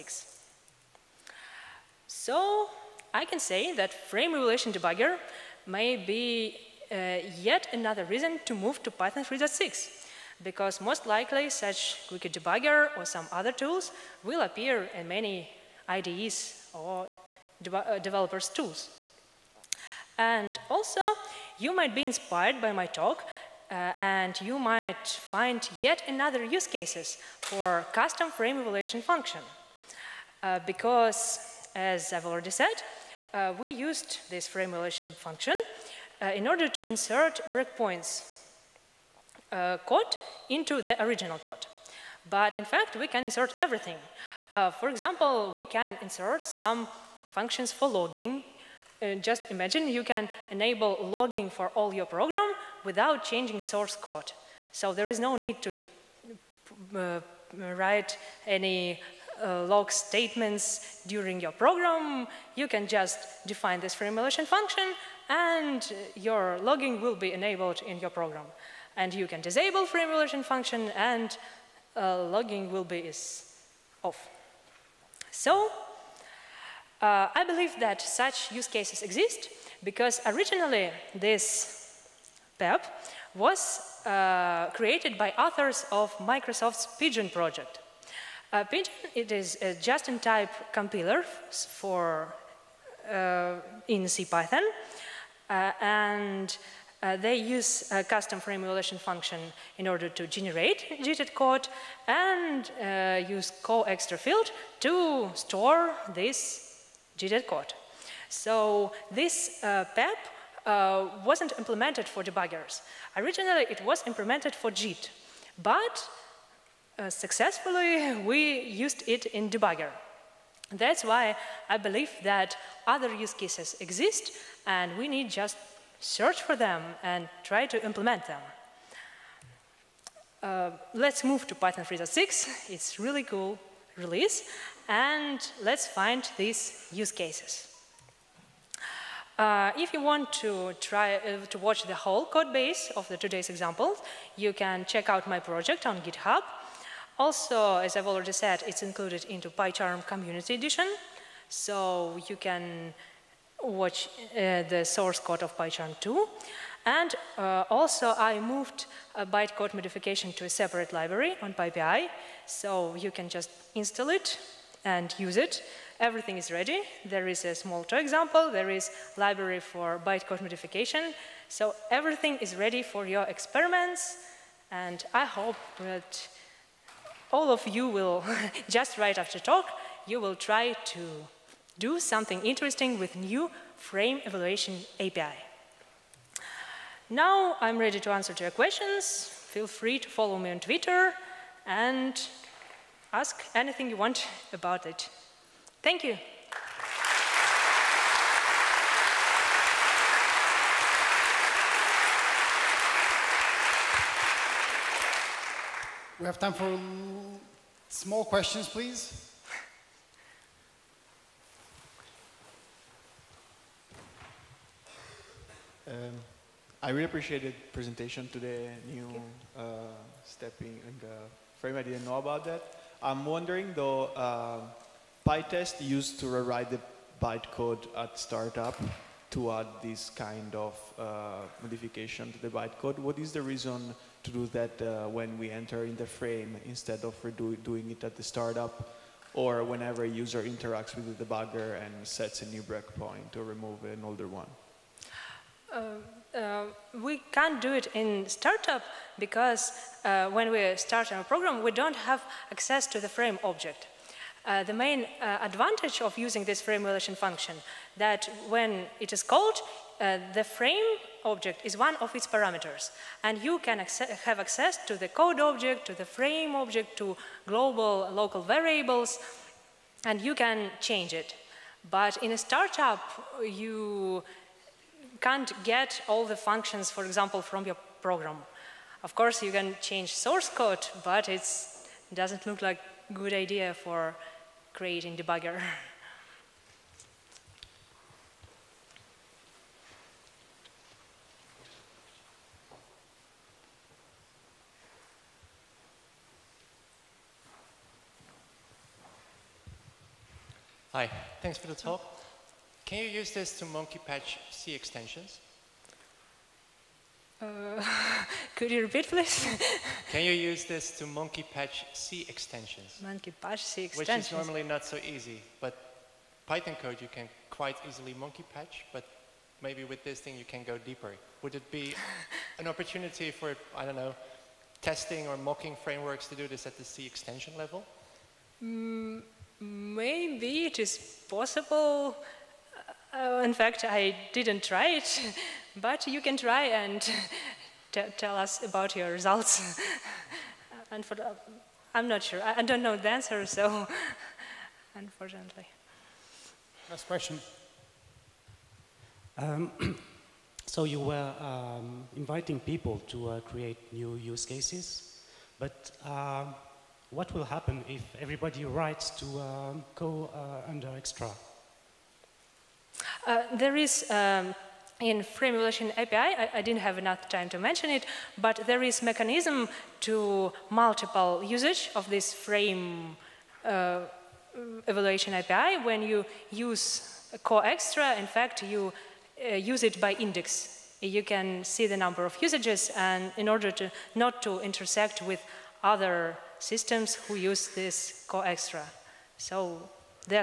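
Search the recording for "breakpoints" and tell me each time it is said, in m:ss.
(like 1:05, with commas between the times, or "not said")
0:37, 4:02.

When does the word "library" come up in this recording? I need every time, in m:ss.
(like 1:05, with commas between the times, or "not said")
2:40, 2:49.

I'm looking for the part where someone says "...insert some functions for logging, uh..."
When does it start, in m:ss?
0:46.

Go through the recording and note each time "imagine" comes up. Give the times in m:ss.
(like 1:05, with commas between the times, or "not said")
0:49.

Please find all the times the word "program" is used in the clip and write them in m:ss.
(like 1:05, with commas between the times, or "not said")
0:52, 1:01, 1:08, 4:11, 4:38.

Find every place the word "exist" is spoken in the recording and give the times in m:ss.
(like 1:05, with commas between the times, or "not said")
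1:19, 2:03.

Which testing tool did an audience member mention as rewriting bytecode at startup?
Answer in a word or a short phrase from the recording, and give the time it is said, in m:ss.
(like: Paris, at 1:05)
PyTest, at 3:45.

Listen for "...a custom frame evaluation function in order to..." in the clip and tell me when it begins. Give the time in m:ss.
1:37.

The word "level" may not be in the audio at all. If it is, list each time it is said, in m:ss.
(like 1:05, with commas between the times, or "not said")
5:27.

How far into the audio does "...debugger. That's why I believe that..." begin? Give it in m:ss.
1:59.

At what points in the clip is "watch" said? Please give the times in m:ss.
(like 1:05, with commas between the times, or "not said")
2:21, 2:33.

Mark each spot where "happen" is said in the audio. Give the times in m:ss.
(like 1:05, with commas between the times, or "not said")
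5:57.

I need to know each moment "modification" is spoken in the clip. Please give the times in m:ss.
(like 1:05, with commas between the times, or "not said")
2:39, 2:50, 3:51.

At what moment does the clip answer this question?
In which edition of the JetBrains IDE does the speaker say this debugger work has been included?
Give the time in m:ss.
2:30.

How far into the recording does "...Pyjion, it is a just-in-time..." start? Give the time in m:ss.
1:28.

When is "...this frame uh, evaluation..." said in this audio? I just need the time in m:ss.
6:12.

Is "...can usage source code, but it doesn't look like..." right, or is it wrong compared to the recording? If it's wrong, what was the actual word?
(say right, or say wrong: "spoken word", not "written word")
wrong: "change", not "usage".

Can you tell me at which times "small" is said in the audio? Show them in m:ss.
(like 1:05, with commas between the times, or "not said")
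2:47, 3:27.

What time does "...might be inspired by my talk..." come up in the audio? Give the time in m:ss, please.
0:21.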